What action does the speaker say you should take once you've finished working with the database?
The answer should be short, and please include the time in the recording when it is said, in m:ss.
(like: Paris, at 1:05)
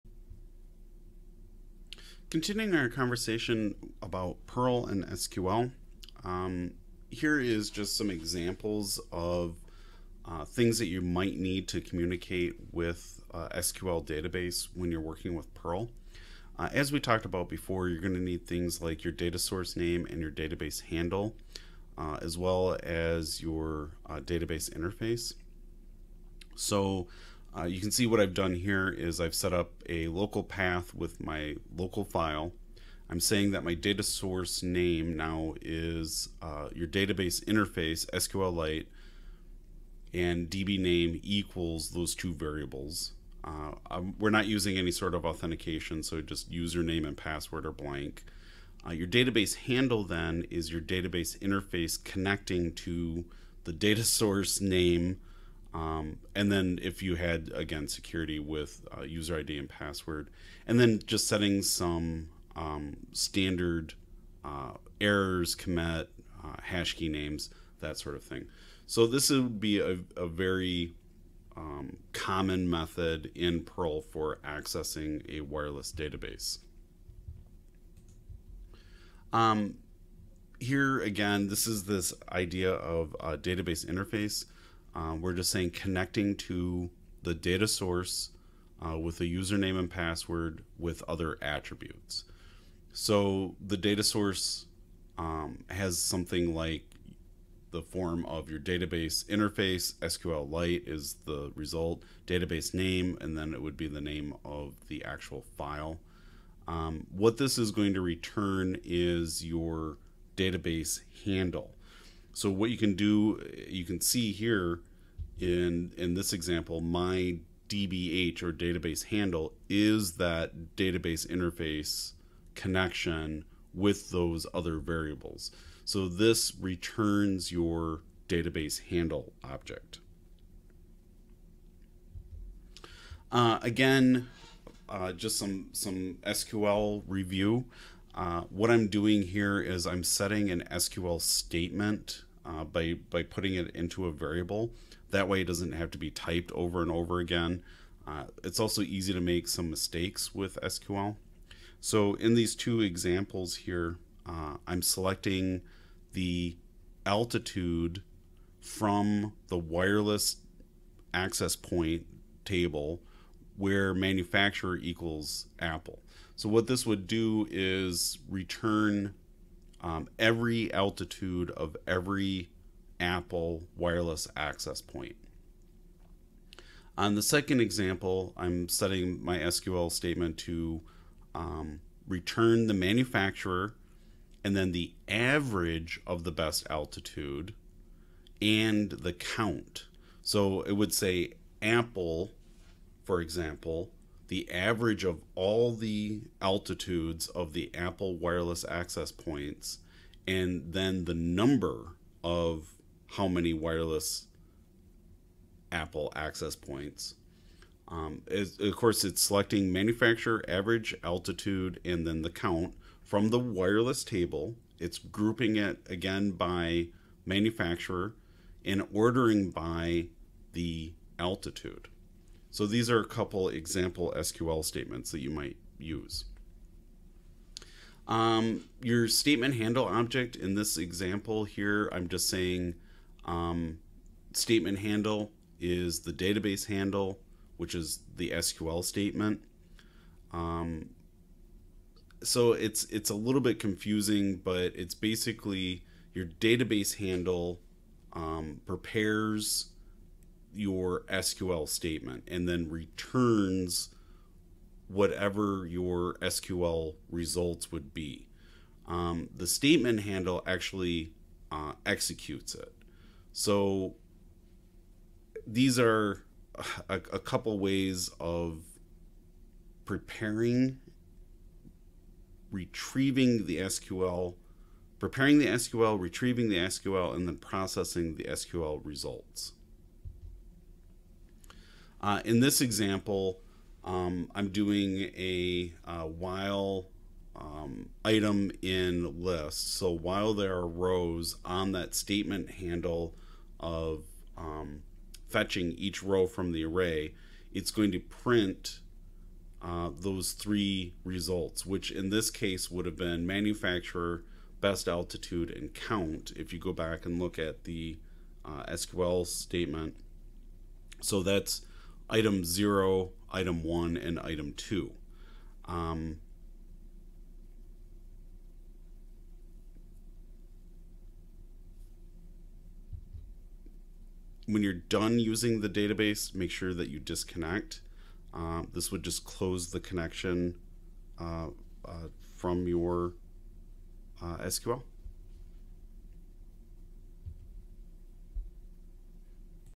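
disconnect, at 5:26.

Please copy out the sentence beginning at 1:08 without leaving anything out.
So this would be a, a very um, common method in Perl for accessing a wireless database.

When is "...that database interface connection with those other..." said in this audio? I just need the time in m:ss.
2:00.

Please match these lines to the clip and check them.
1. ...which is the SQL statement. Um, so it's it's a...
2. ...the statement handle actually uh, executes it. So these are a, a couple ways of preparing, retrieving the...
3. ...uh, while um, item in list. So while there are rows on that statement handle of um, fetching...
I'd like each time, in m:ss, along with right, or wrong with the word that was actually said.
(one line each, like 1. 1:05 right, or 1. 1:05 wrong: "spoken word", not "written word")
1. 3:57 right
2. 4:19 right
3. 4:45 right.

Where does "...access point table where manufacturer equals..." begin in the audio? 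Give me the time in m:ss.
2:41.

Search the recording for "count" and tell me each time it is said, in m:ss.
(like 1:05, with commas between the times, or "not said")
3:09, 3:32, 5:05.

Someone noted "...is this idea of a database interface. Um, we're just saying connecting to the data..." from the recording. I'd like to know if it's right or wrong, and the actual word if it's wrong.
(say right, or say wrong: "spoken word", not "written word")
right.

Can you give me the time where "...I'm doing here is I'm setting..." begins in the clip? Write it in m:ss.
2:18.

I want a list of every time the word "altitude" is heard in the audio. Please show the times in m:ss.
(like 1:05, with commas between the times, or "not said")
2:37, 2:50, 3:06, 3:16, 3:31, 3:41, 5:04.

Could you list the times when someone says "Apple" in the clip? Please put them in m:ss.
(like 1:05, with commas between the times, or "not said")
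2:45, 2:52, 3:11, 3:17, 3:25.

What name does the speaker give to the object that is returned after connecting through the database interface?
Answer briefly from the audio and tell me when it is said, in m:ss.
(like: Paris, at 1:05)
database handle object, at 2:08.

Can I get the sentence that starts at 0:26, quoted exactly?
So uh, you can see what I've done here is I've set up a local path with my local file.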